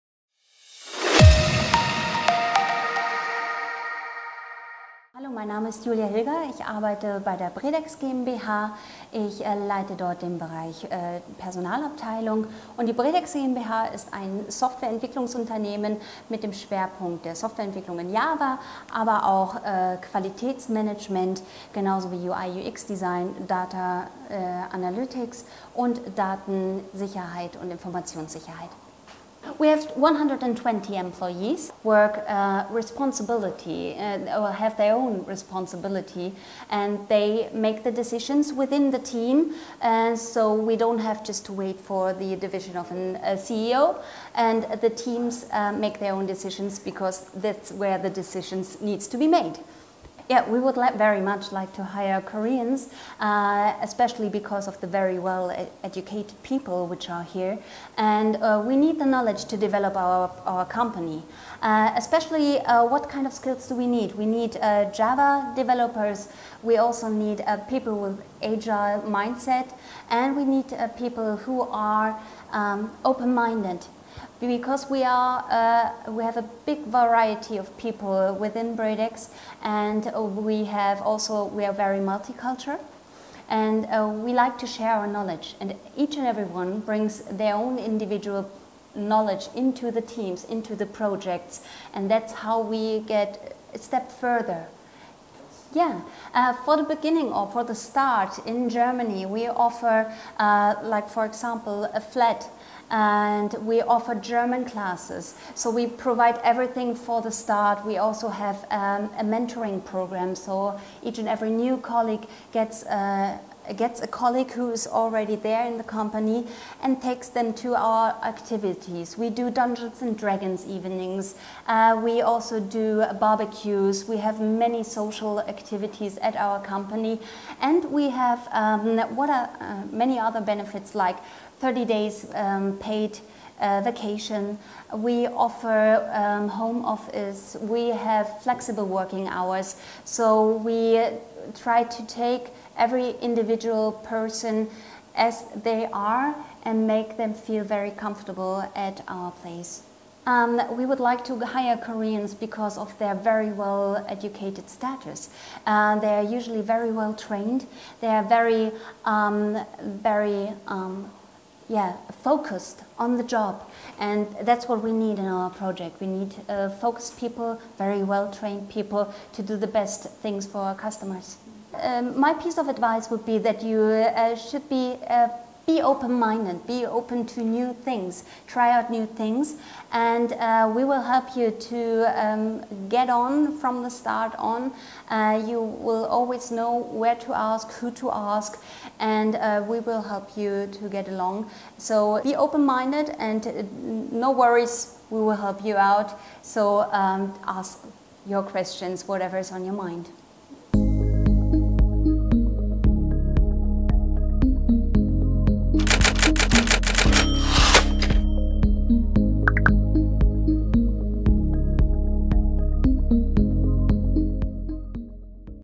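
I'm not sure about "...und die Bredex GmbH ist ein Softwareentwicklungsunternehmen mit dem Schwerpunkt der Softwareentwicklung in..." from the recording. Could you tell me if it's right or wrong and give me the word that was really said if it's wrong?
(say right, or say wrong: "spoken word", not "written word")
right.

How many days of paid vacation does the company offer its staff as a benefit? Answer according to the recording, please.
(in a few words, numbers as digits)
30.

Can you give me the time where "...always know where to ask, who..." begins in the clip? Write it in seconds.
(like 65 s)
186 s.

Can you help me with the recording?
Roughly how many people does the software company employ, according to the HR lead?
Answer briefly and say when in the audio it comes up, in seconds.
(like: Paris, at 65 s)
120, at 29 s.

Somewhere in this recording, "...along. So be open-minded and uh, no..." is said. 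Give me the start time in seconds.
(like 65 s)
191 s.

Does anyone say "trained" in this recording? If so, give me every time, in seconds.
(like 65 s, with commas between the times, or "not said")
157 s, 168 s.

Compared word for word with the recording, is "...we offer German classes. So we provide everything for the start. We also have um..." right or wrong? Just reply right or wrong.
right.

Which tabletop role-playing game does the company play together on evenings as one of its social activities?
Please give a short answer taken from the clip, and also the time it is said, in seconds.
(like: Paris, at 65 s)
Dungeons and Dragons, at 119 s.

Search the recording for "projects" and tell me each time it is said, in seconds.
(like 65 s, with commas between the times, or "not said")
90 s, 165 s.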